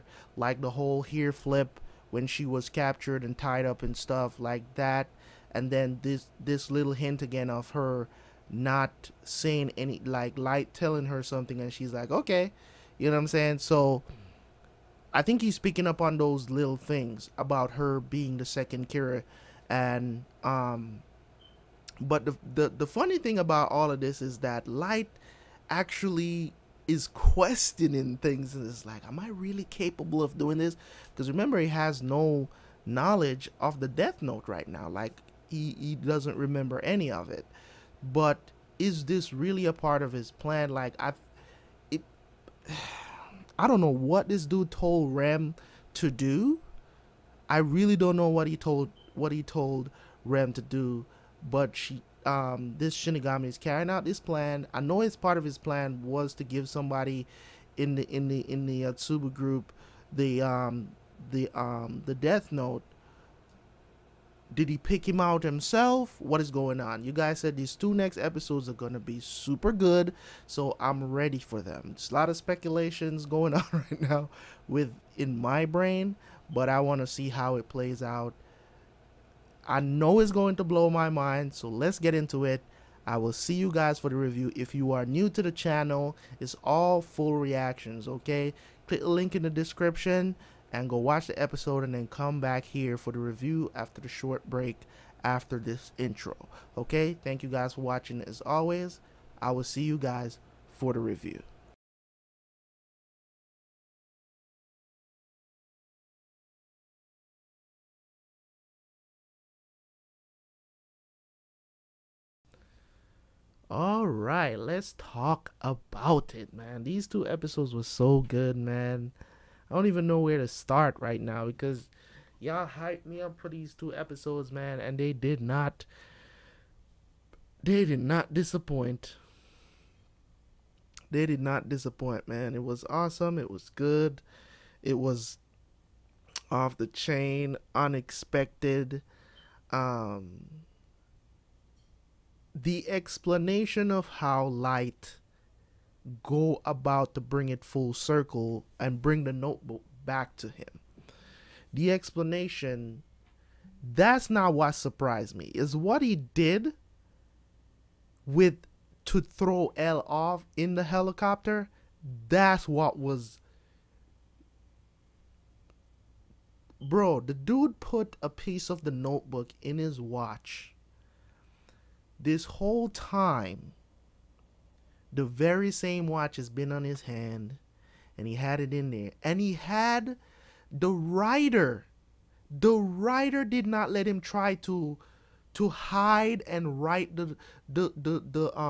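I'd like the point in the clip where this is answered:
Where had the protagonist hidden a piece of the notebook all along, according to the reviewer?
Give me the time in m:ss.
2:49.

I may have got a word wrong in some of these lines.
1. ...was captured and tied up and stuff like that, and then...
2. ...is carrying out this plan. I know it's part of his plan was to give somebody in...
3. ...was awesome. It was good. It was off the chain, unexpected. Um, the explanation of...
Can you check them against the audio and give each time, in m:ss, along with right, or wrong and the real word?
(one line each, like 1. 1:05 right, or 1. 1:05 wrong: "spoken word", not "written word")
1. 0:02 right
2. 0:53 right
3. 2:12 right.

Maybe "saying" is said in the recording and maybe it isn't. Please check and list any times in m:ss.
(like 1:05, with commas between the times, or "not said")
0:09, 0:13.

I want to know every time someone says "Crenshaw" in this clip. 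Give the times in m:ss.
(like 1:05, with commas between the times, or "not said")
not said.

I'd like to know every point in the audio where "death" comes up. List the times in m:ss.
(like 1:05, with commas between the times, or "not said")
0:33, 1:02.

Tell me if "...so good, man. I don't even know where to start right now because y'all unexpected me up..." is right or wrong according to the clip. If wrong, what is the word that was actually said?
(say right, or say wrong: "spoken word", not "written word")
wrong: "hyped", not "unexpected".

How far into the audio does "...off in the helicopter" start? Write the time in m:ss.
2:40.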